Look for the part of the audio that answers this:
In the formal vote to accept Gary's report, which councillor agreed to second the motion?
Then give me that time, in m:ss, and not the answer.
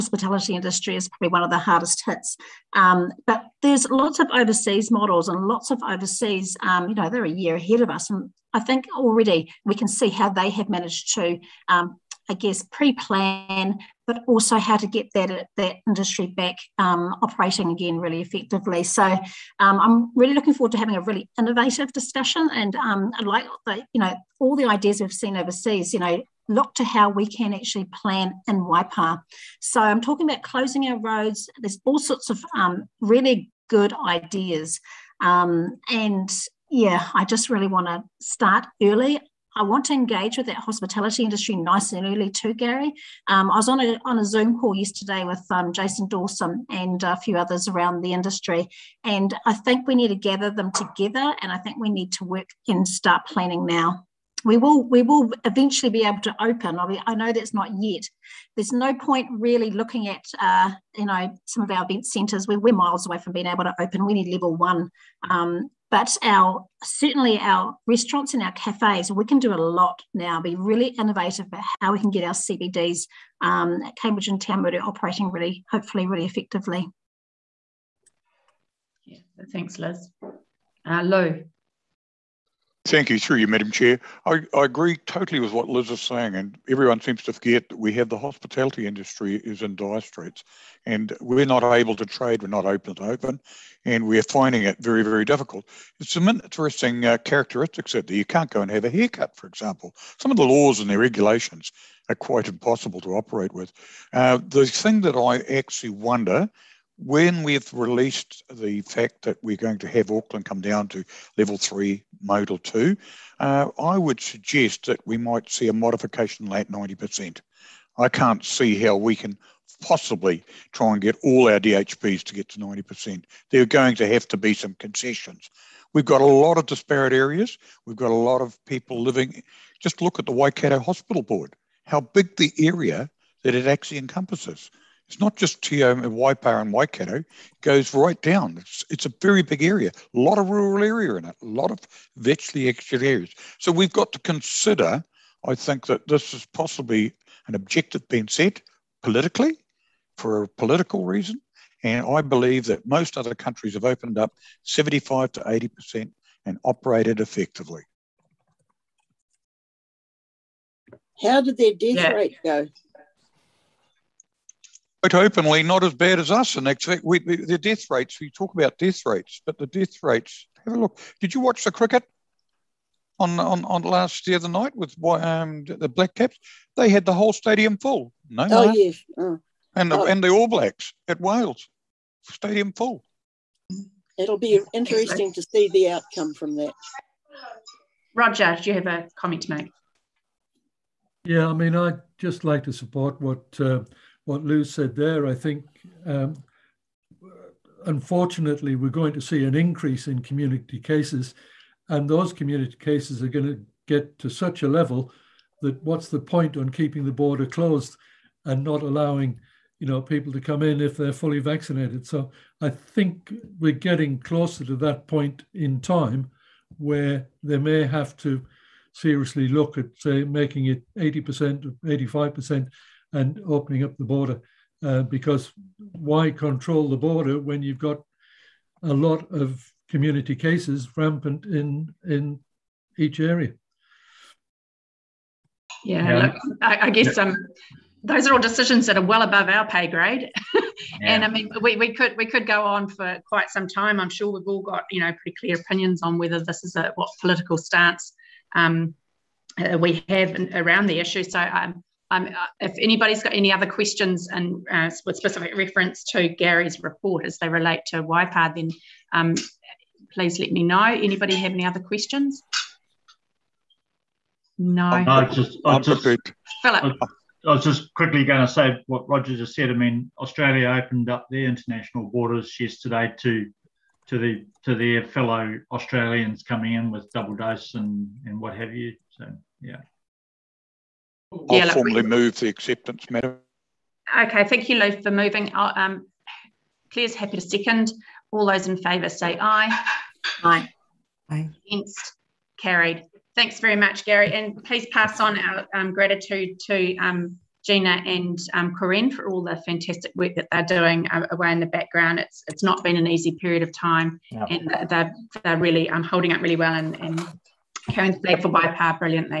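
4:46.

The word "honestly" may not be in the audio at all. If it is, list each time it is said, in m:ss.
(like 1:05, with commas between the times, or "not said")
not said.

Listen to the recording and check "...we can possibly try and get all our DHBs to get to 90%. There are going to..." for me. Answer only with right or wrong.
right.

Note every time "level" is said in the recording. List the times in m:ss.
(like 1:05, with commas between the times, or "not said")
1:04, 1:51, 3:24.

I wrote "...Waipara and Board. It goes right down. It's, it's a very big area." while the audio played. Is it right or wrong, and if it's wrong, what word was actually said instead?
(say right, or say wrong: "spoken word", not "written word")
wrong: "Waikato", not "Board".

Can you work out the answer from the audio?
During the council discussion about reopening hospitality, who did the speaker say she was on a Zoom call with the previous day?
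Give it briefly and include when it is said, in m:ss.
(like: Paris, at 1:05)
Jason Dawson, at 0:45.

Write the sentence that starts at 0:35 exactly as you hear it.
Um, and yeah, I just really want to start early.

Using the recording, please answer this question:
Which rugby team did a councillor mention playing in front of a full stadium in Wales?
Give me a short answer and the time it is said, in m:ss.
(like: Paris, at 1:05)
All Blacks, at 3:00.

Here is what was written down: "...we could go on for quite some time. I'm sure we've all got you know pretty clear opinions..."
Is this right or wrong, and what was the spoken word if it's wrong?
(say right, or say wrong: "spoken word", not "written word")
right.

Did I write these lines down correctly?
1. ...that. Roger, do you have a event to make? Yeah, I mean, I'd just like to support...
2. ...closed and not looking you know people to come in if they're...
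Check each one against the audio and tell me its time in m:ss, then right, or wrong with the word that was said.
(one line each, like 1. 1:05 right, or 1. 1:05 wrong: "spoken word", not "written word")
1. 3:06 wrong: "comment", not "event"
2. 3:27 wrong: "allowing", not "looking".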